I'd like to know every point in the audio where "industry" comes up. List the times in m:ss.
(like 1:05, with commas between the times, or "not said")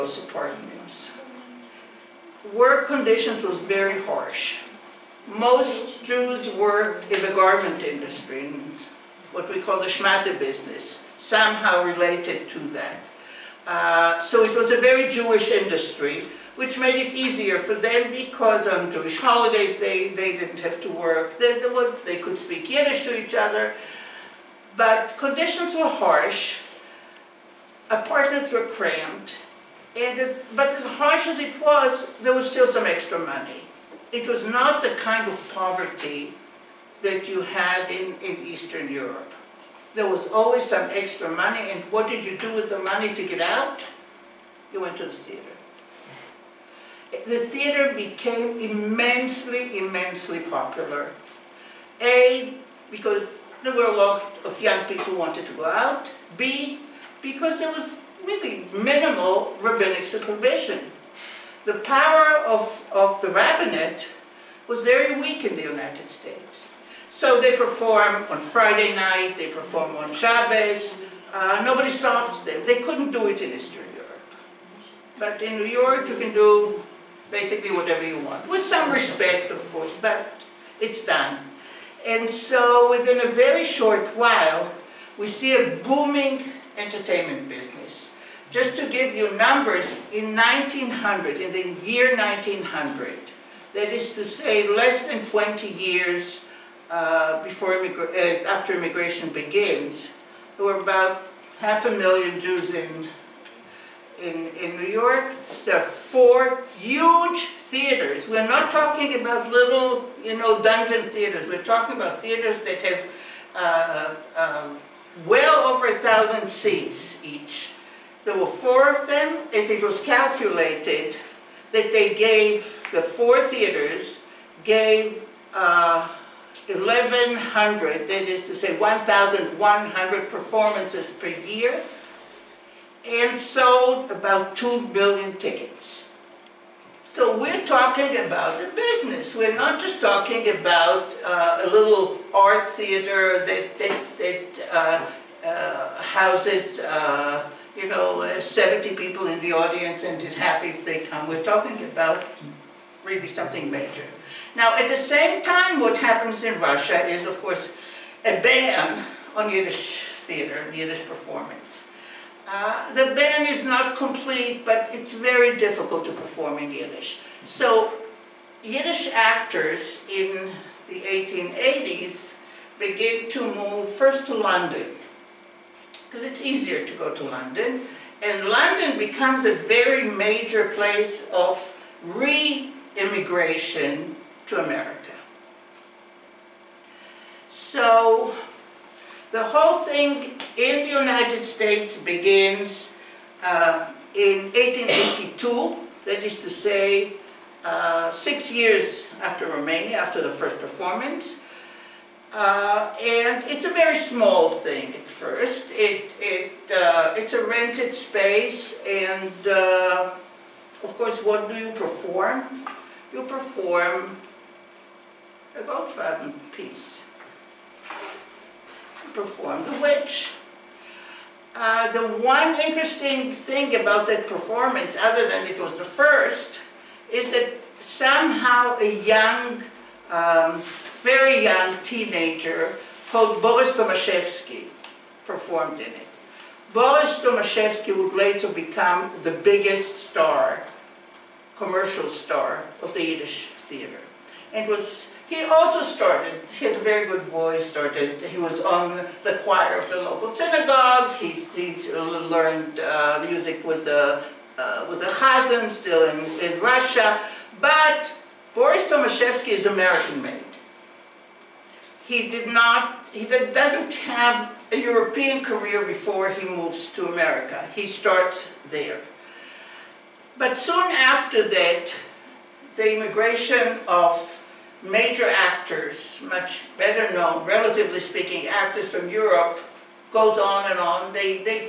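0:07, 0:15.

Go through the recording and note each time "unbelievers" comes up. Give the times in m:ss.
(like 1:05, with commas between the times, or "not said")
not said.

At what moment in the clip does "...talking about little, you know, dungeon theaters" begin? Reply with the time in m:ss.
1:48.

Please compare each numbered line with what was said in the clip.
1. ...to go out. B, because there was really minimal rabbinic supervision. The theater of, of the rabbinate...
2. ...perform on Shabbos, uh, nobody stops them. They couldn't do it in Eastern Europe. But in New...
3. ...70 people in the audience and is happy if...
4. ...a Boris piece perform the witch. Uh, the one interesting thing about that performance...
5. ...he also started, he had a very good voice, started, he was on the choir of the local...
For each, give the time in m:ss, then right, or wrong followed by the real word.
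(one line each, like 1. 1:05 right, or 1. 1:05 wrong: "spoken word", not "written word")
1. 0:55 wrong: "power", not "theater"
2. 1:09 right
3. 2:28 right
4. 3:35 wrong: "Goldfaden", not "Boris"
5. 4:05 right.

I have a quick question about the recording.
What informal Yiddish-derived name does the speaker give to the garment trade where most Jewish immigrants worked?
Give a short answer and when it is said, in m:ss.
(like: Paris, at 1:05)
shmata business, at 0:09.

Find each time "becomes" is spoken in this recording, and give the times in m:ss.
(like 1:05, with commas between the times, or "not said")
2:58, 3:58.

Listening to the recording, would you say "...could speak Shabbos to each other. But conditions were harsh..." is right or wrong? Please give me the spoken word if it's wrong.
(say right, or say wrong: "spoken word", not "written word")
wrong: "Yiddish", not "Shabbos".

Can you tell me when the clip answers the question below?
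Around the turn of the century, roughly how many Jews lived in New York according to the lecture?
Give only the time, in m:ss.
1:41.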